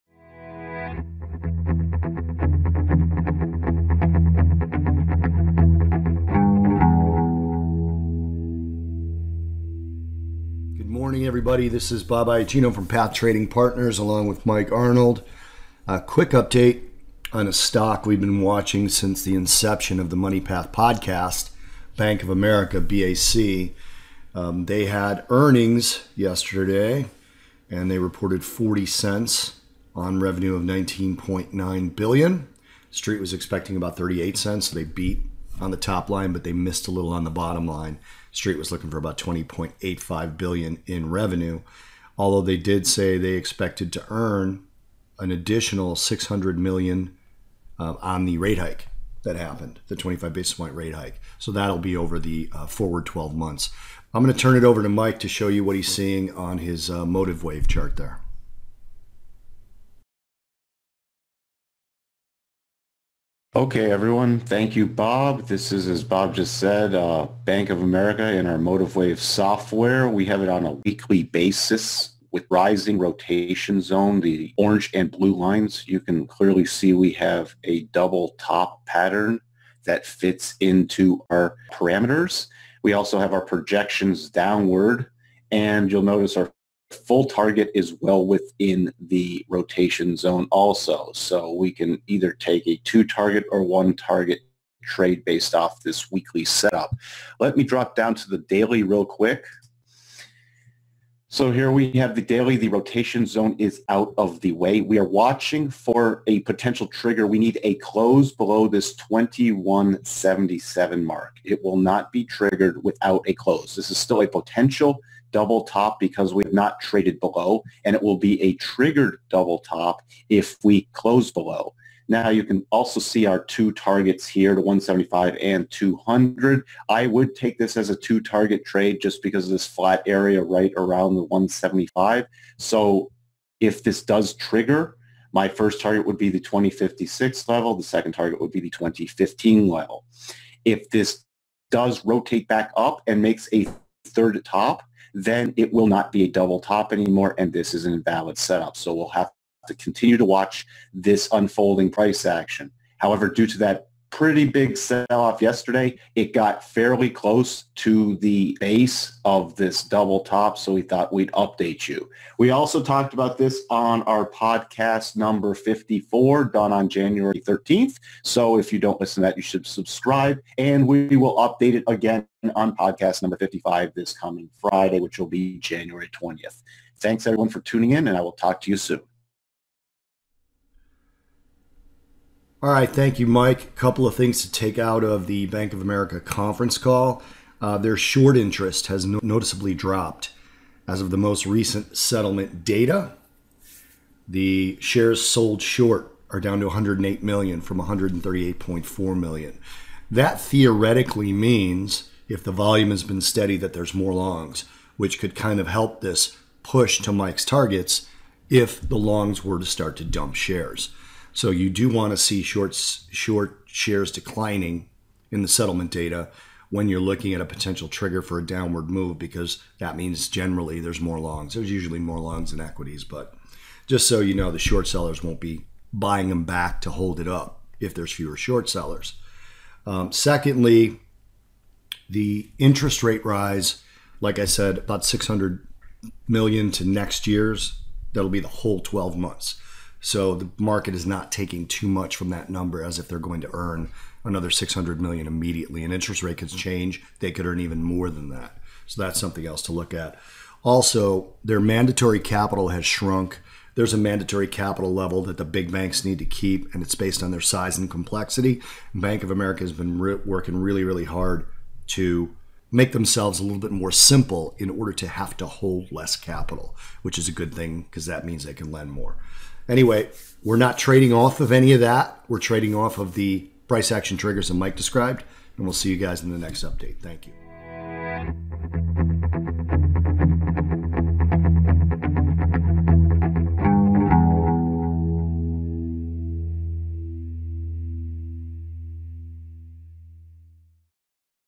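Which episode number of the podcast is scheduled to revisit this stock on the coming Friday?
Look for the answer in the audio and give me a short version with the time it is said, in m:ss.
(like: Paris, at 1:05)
55, at 2:53.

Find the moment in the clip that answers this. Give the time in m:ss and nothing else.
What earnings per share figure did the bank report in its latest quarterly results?
0:28.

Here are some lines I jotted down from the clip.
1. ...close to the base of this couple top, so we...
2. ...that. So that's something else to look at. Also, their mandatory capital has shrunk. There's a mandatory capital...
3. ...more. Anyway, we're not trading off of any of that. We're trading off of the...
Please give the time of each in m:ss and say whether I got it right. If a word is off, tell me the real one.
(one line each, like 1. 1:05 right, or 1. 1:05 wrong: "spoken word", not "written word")
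1. 2:37 wrong: "double", not "couple"
2. 4:08 right
3. 4:28 right.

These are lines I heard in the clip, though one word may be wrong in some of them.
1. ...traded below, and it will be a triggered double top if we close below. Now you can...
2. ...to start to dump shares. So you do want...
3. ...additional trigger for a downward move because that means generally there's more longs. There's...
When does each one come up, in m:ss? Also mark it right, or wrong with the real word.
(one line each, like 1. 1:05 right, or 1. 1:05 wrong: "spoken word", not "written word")
1. 1:56 right
2. 3:29 right
3. 3:37 wrong: "potential", not "additional".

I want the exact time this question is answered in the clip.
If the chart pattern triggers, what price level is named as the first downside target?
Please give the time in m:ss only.
2:16.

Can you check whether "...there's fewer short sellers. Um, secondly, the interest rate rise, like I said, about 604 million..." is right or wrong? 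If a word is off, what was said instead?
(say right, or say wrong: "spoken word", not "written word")
wrong: "600", not "604".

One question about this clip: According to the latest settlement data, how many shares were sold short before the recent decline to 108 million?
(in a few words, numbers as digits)
138.4 million.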